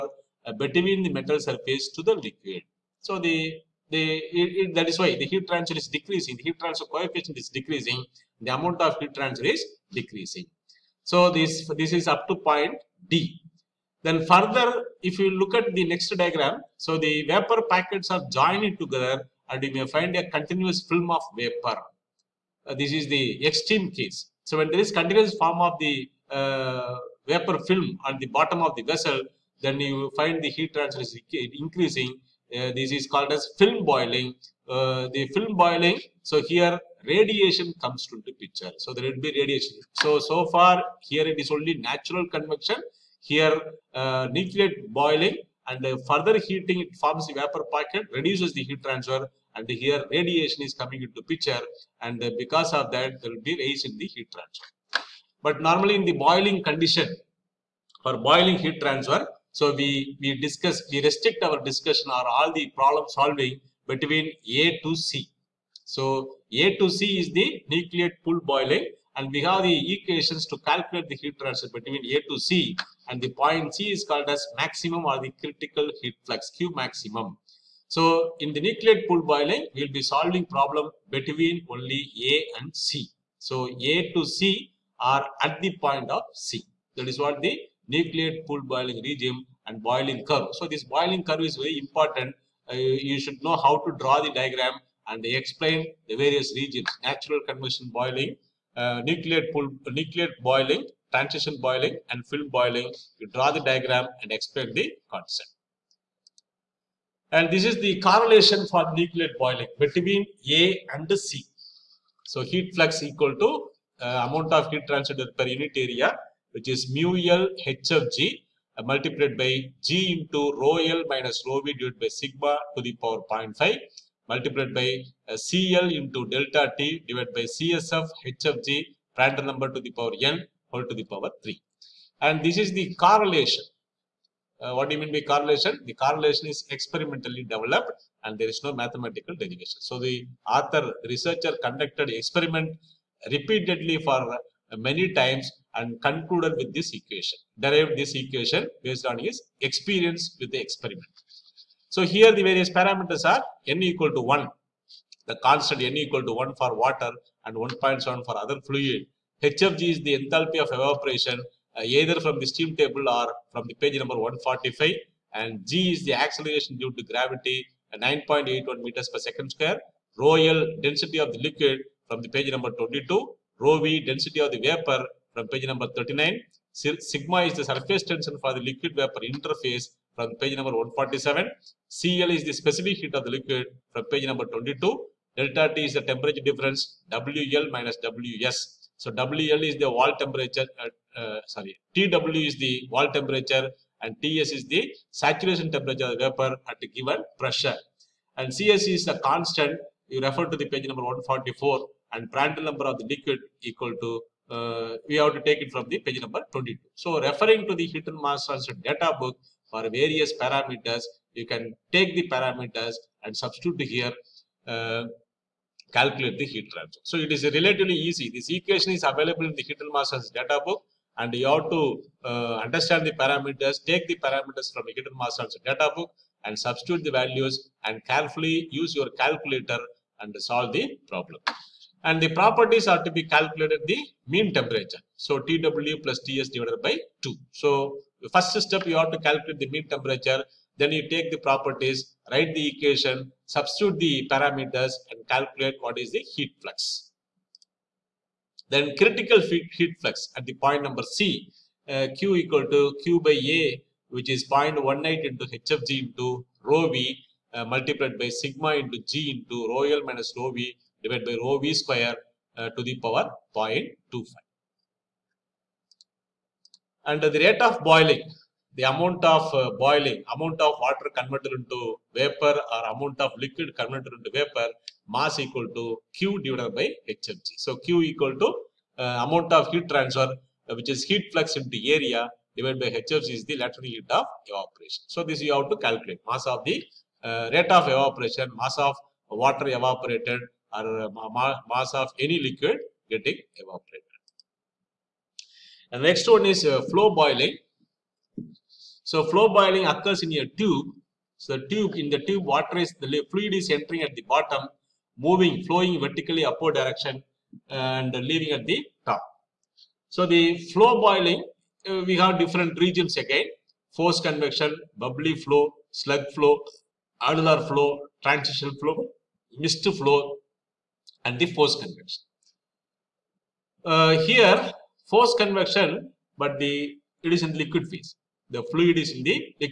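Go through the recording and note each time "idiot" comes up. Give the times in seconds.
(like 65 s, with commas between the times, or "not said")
not said.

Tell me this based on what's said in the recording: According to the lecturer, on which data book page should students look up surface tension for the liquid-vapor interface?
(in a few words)
147.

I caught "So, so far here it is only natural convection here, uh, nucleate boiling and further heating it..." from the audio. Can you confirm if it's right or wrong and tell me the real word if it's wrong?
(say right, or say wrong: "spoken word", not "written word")
right.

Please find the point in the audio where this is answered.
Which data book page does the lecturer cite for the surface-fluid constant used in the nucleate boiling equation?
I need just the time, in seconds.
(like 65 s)
200 s.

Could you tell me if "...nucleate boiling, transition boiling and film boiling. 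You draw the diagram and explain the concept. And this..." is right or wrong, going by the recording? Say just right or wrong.
right.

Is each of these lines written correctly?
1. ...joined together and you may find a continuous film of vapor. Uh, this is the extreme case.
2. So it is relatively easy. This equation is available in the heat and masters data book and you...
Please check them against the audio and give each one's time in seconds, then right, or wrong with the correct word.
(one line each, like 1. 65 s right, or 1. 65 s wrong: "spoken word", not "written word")
1. 18 s right
2. 217 s right.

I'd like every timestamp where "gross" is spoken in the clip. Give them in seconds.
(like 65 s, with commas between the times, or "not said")
not said.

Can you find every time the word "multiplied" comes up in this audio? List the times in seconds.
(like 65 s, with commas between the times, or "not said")
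118 s, 124 s, 257 s.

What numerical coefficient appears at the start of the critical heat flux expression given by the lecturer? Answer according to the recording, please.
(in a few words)
0.18.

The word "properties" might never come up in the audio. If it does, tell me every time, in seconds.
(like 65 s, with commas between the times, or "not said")
232 s, 241 s.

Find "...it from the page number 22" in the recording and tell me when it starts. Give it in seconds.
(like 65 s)
205 s.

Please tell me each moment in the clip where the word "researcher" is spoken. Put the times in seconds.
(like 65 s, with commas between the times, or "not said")
141 s.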